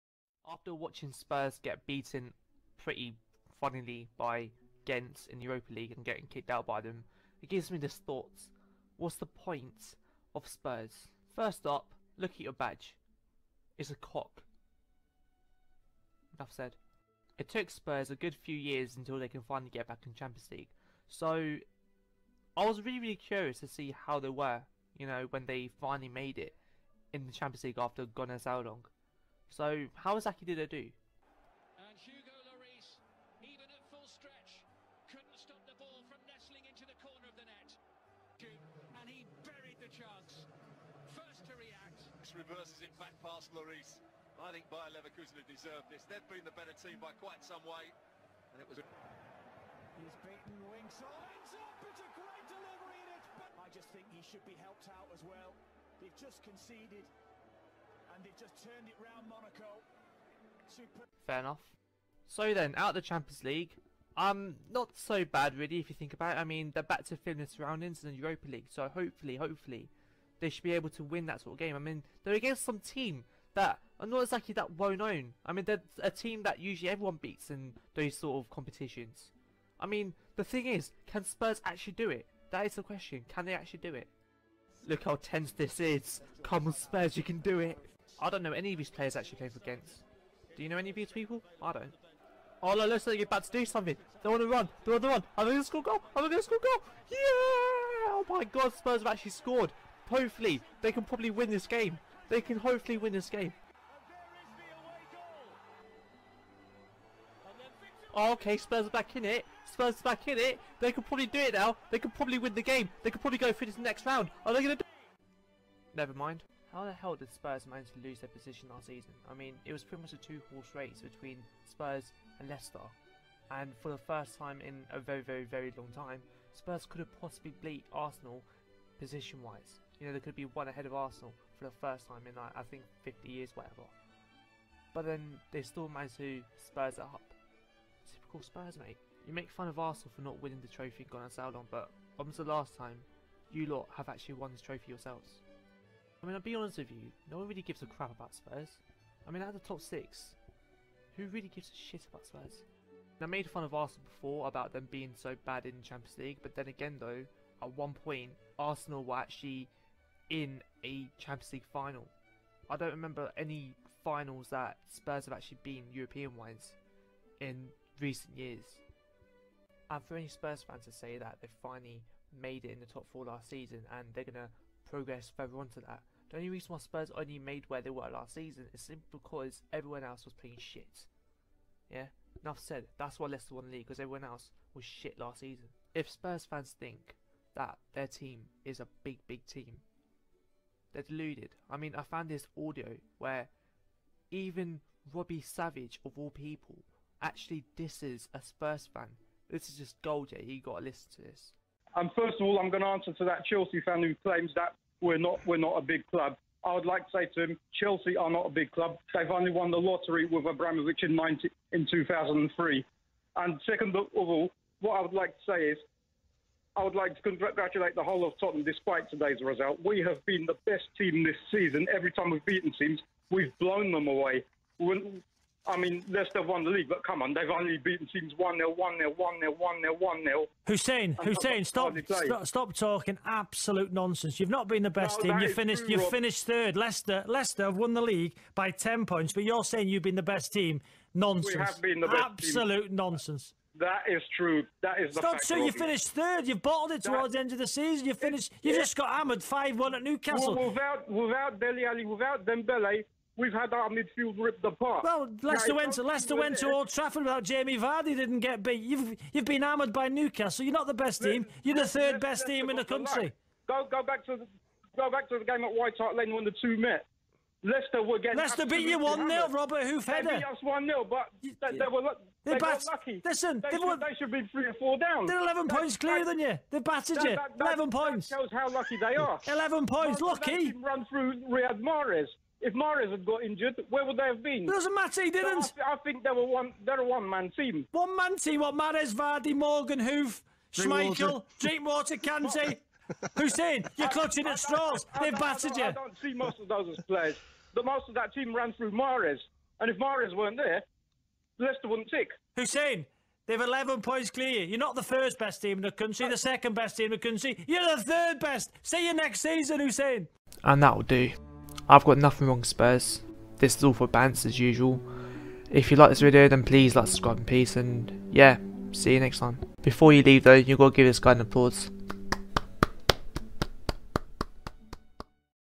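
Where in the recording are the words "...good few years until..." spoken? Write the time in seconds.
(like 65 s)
18 s.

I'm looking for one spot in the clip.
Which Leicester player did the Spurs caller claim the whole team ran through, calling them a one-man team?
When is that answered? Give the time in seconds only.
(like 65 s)
281 s.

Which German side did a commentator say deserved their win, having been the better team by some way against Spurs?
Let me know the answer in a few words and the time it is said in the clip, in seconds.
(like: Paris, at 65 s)
Bayer Leverkusen, at 44 s.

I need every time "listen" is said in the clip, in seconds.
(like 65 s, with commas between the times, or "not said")
200 s, 273 s.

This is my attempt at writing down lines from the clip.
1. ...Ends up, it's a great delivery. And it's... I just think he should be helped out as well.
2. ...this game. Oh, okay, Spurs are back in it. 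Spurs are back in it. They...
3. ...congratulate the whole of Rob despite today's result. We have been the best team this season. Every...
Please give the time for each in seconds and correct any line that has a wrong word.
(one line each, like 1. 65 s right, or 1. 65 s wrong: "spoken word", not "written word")
1. 51 s right
2. 103 s right
3. 217 s wrong: "Tottenham", not "Rob".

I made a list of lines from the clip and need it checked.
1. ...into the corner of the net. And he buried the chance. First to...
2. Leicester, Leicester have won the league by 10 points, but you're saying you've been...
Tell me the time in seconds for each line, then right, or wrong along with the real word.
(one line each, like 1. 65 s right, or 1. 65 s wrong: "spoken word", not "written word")
1. 36 s right
2. 236 s right.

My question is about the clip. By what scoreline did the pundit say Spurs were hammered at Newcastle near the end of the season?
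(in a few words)
5-1.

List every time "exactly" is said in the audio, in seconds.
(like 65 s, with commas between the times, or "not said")
30 s, 74 s.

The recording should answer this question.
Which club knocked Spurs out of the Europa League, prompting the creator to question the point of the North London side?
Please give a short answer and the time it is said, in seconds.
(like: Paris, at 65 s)
Ghent, at 4 s.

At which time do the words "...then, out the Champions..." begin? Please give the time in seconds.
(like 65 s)
62 s.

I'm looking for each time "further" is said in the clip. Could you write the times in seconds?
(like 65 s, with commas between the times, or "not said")
175 s.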